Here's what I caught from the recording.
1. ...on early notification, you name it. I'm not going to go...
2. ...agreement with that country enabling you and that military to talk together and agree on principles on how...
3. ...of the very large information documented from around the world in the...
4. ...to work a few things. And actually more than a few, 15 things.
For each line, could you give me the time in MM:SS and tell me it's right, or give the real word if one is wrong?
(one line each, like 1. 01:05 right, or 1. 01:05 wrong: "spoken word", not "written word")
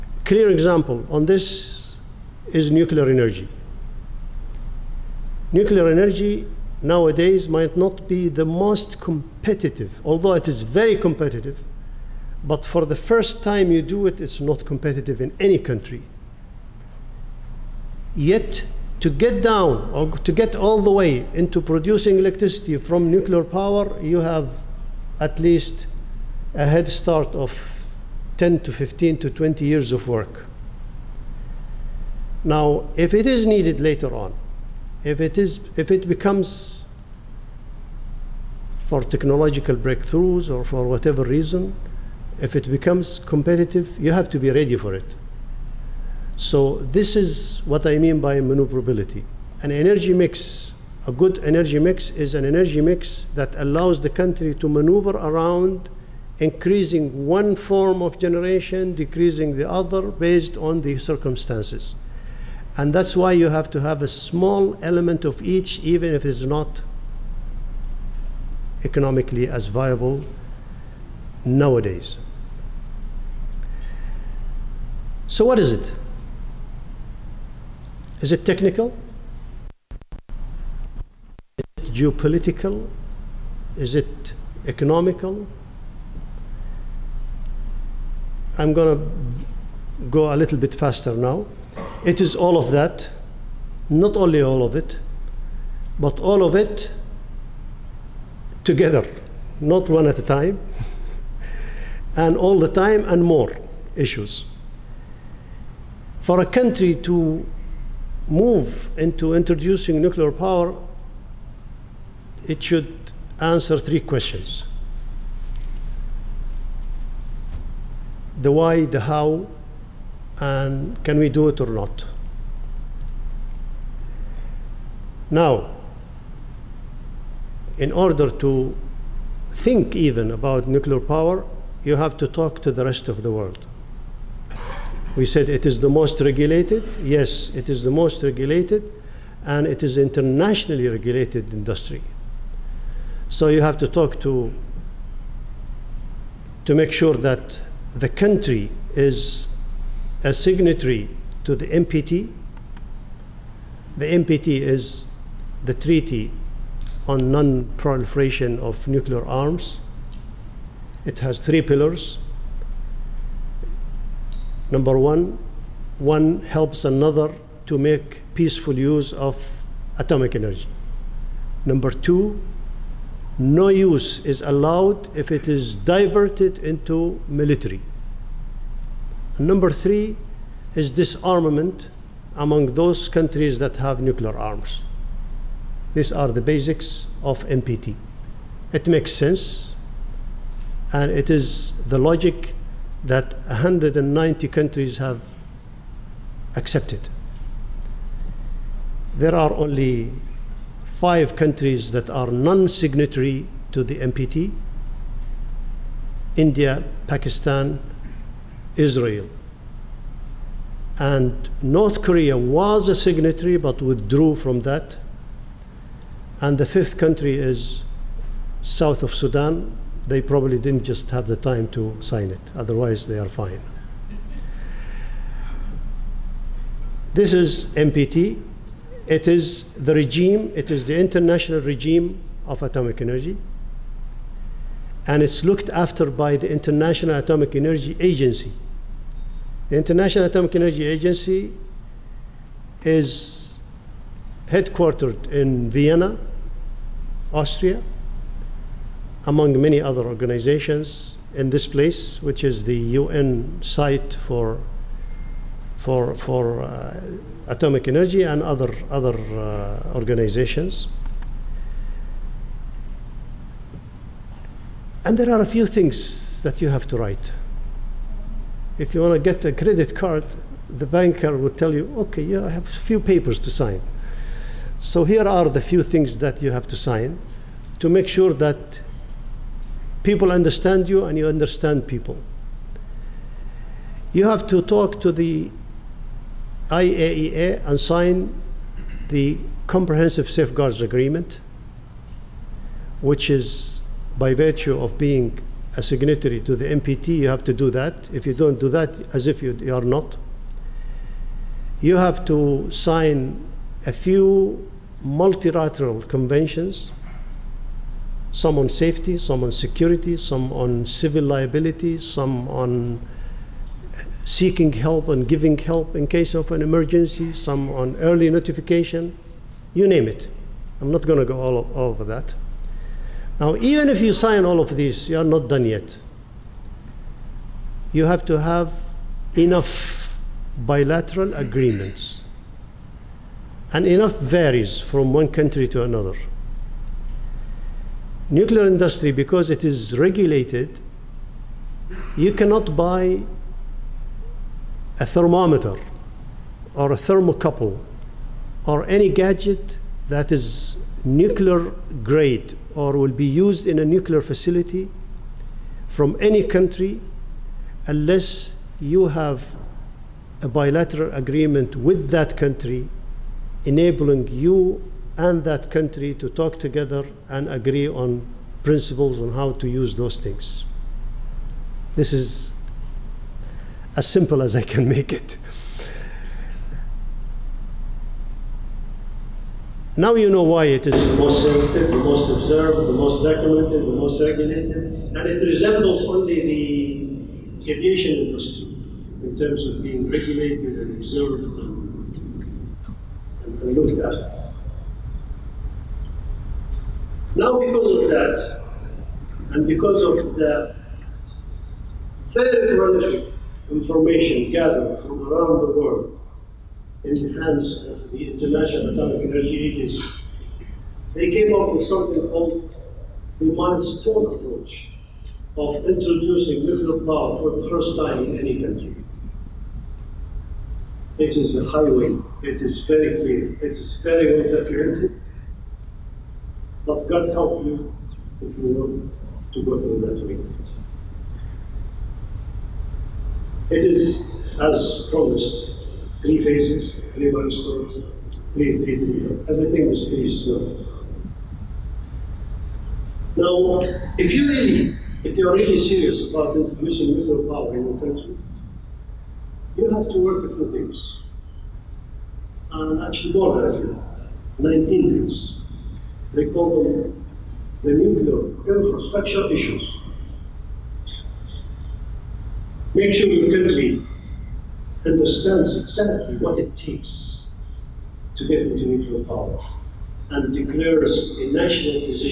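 1. 05:17 right
2. 06:01 wrong: "country", not "military"
3. 06:40 wrong: "gathered", not "documented"
4. 07:30 wrong: "19", not "15".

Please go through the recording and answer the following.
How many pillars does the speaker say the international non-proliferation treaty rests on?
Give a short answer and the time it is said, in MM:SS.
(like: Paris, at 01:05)
3, at 02:41.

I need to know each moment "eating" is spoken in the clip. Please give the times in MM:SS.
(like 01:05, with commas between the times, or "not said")
not said.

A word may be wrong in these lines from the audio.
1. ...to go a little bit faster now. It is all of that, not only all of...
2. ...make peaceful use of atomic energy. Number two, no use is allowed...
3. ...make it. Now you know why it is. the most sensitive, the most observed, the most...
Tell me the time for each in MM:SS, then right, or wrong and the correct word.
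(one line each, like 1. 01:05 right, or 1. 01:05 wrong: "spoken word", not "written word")
1. 01:28 right
2. 02:47 right
3. 06:14 right.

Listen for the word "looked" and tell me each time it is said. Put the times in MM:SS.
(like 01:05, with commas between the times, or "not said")
03:55, 06:33.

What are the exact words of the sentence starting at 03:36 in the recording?
And the fifth country is south of Sudan, they probably didn't just have the time to sign it.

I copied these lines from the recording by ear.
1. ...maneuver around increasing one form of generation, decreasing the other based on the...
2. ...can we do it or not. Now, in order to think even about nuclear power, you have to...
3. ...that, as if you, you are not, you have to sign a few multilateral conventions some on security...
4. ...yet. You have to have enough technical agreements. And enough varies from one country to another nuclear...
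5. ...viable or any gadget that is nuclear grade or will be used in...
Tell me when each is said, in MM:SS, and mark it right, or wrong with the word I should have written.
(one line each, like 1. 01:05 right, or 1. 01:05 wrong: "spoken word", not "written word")
1. 00:54 right
2. 02:01 right
3. 04:58 wrong: "safety", not "security"
4. 05:25 wrong: "bilateral", not "technical"
5. 05:46 wrong: "thermocouple", not "viable".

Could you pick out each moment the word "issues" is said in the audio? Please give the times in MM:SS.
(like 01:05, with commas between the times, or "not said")
01:43, 07:39.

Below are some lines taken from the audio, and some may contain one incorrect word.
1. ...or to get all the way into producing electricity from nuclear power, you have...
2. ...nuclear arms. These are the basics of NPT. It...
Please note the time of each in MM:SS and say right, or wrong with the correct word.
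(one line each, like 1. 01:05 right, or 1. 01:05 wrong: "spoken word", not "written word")
1. 00:19 right
2. 03:04 right.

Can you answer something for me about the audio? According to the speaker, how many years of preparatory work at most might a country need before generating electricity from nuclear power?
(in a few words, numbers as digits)
20.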